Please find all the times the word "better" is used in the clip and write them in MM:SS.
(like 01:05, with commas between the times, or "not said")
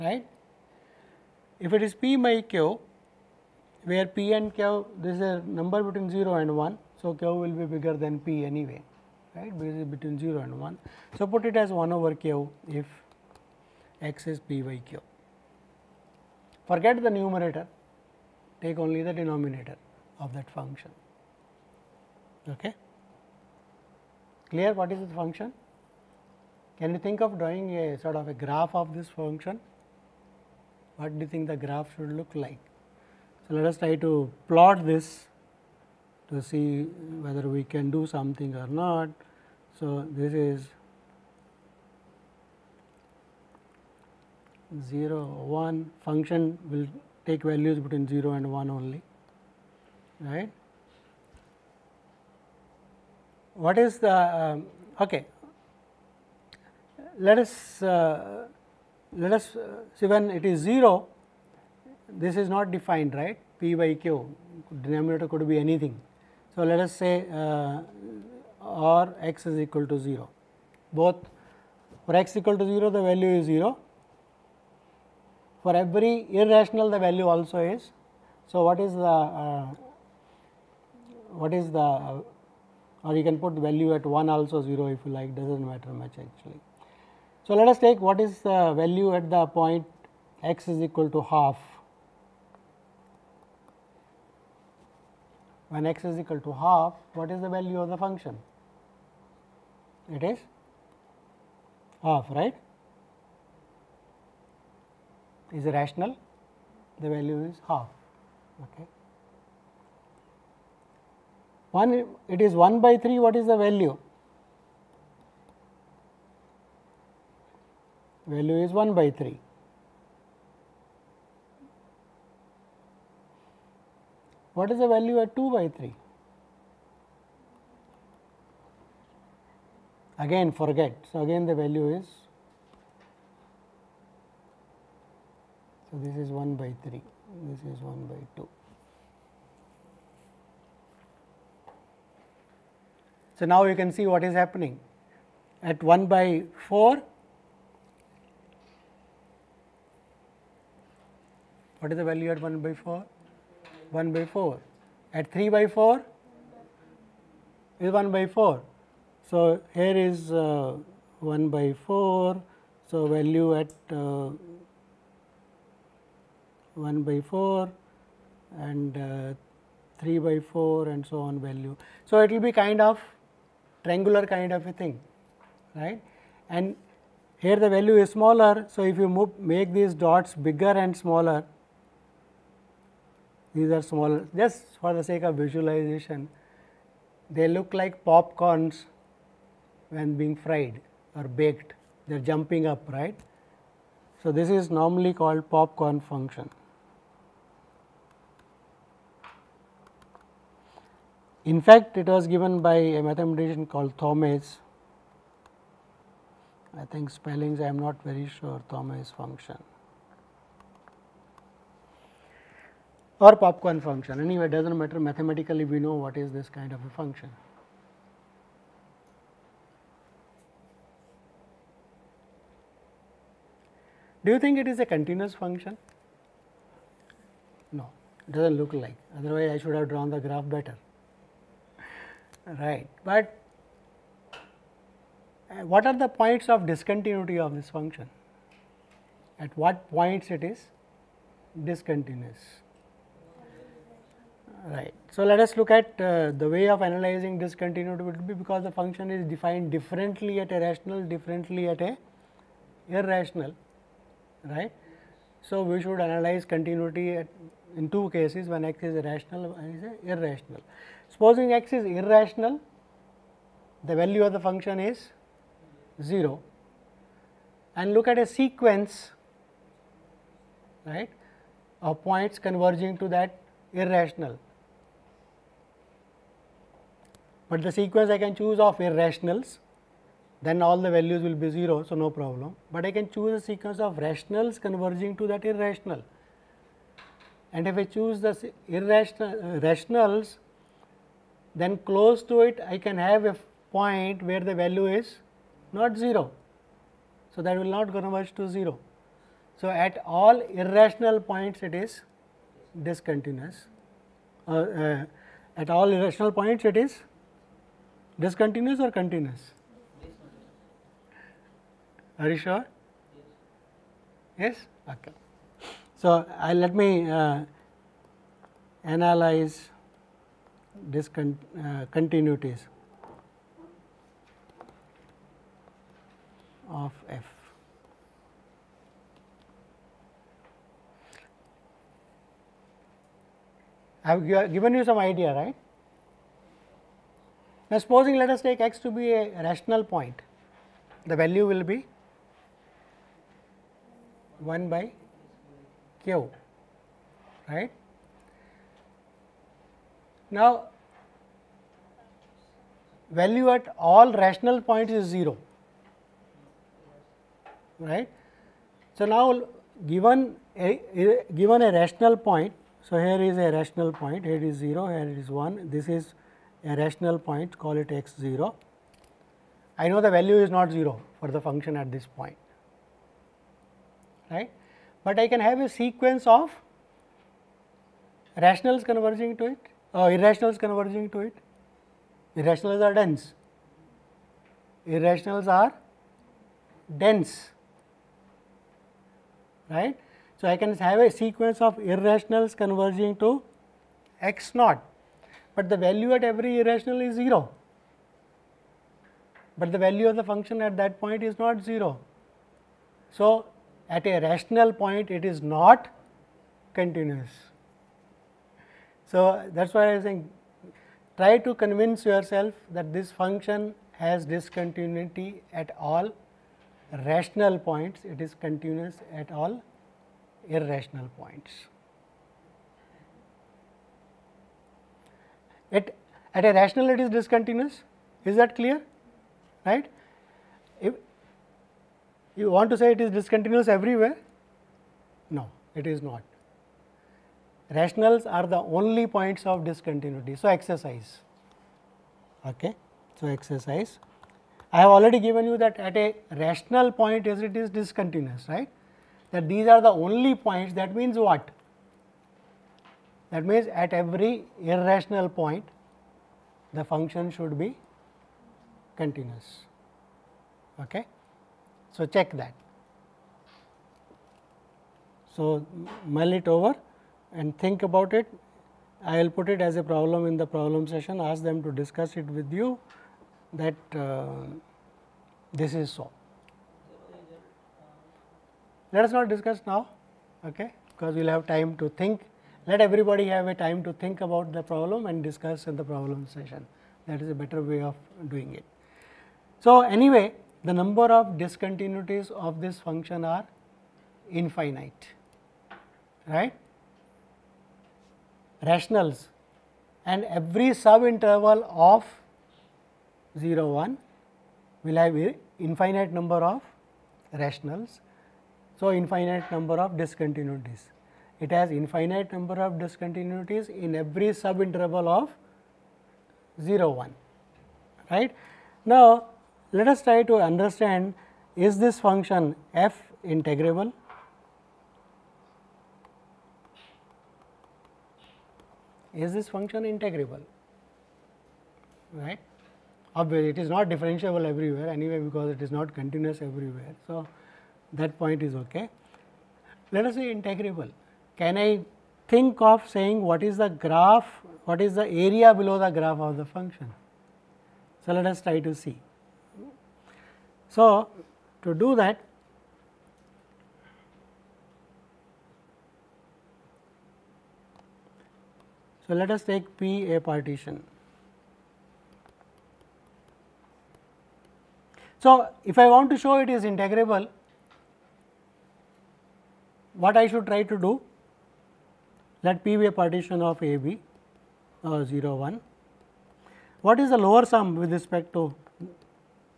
03:50, 08:07.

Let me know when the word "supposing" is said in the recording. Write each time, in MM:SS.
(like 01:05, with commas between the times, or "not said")
04:21, 05:37.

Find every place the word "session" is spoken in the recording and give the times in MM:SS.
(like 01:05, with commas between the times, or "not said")
07:50, 08:06.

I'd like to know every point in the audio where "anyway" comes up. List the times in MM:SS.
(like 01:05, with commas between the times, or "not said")
00:08, 03:34, 08:09, 08:54.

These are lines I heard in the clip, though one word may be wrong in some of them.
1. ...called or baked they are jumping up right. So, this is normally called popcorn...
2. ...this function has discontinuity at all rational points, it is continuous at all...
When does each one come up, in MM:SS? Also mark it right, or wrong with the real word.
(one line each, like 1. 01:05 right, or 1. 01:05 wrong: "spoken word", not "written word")
1. 03:10 wrong: "fried", not "called"
2. 06:52 right.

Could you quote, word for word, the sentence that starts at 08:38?
Now, let us try to understand is this function f integrable?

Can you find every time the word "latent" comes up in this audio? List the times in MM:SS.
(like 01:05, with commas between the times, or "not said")
not said.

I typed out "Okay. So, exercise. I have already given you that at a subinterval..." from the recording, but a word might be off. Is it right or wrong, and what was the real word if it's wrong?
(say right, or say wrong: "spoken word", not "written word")
wrong: "rational", not "subinterval".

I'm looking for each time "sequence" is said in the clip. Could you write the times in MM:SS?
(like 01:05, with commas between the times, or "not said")
04:28, 04:37, 04:43, 06:15, 06:31.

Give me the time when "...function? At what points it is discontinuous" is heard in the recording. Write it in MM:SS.
03:57.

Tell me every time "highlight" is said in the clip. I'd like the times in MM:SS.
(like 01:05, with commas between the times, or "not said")
not said.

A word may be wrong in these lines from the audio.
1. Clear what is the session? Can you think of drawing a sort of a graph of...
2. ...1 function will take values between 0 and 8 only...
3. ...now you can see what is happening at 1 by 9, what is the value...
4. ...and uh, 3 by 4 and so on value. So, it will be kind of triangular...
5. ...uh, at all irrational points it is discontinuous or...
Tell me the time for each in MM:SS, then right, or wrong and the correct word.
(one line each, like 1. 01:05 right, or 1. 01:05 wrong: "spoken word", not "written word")
1. 00:24 wrong: "function", not "session"
2. 00:45 wrong: "1", not "8"
3. 02:23 wrong: "4", not "9"
4. 02:48 right
5. 05:04 right.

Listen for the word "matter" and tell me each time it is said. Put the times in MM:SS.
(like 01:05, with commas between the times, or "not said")
01:25, 03:34.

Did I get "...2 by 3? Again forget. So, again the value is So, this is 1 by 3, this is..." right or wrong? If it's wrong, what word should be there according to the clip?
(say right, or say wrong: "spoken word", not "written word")
right.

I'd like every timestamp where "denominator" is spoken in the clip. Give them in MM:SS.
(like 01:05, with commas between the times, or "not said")
00:19, 01:04.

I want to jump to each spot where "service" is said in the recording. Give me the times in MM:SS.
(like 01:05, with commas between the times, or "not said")
not said.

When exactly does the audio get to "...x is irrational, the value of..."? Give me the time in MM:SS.
04:21.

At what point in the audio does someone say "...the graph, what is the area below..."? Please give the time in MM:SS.
09:03.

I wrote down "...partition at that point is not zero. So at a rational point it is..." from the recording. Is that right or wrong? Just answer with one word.
wrong.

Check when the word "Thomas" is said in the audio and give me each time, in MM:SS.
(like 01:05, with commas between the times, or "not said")
03:23, 03:28.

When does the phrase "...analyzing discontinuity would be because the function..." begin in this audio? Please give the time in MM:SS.
04:06.